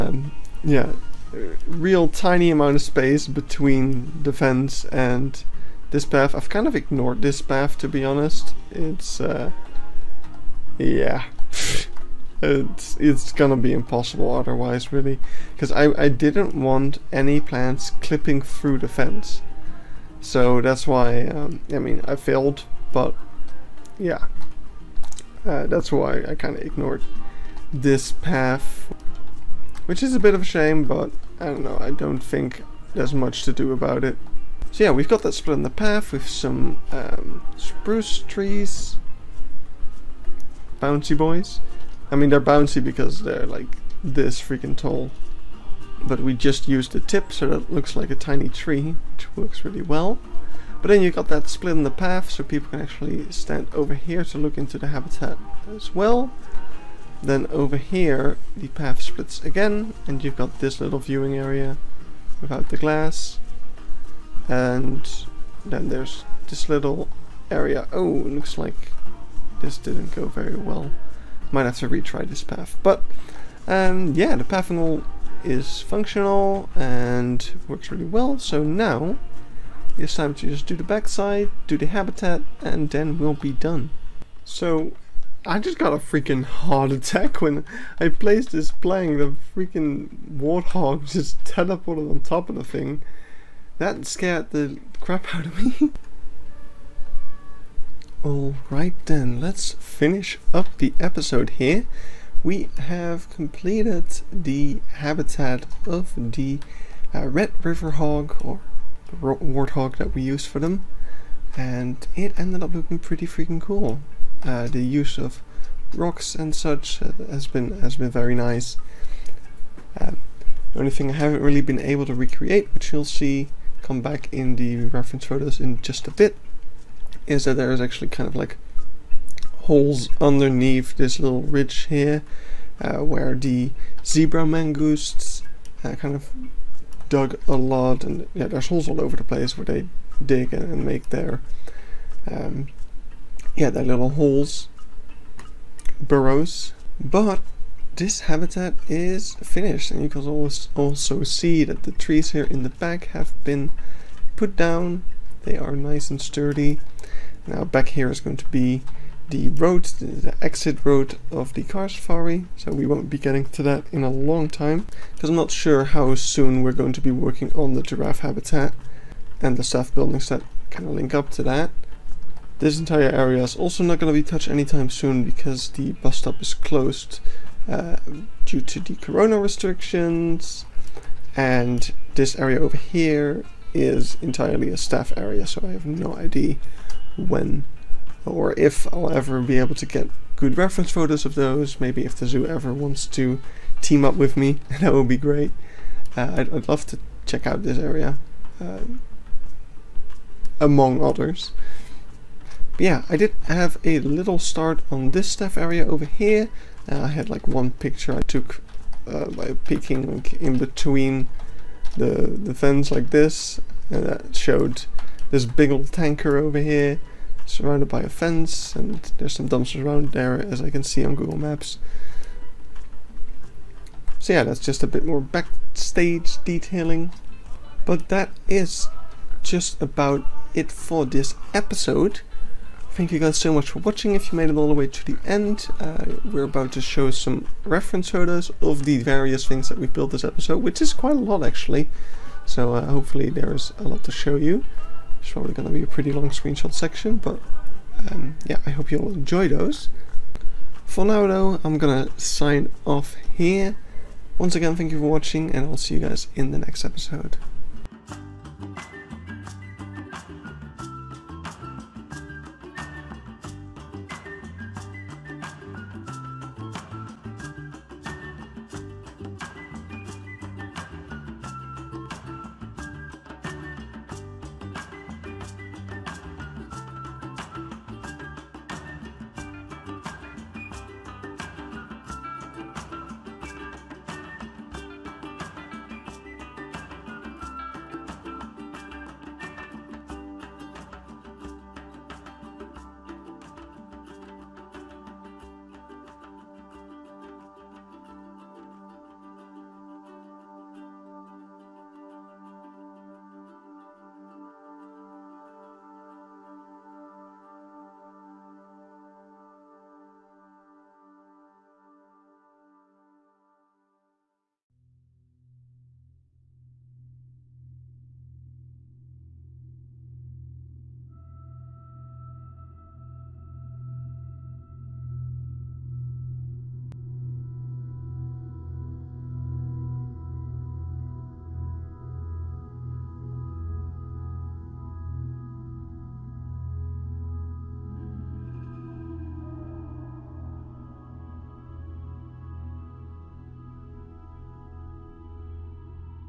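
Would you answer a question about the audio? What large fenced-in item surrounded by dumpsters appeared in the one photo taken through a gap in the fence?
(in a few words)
Tanker.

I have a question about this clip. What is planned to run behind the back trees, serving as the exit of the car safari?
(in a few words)
The road.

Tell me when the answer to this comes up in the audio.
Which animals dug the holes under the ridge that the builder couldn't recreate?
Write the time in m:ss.
2:14.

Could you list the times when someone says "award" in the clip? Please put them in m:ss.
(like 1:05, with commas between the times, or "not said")
not said.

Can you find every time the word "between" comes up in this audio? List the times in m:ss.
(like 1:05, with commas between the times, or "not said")
0:03, 3:30.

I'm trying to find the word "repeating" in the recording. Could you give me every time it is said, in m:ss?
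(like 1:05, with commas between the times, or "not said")
not said.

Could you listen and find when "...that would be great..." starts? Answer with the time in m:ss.
3:14.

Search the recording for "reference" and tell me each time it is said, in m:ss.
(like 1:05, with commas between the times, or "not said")
2:04, 3:10, 3:57.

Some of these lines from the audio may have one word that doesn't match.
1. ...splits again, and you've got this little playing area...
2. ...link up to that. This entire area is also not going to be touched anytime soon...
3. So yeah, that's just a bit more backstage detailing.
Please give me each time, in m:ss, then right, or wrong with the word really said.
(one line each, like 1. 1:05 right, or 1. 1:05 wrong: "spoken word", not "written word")
1. 0:59 wrong: "viewing", not "playing"
2. 2:50 right
3. 3:44 right.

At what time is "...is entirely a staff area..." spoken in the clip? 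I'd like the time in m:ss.
3:03.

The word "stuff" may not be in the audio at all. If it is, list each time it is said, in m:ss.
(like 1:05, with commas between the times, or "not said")
3:25.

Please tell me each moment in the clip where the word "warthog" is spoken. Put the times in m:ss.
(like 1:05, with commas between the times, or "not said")
1:30, 1:49.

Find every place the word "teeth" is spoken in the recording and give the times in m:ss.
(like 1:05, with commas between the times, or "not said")
not said.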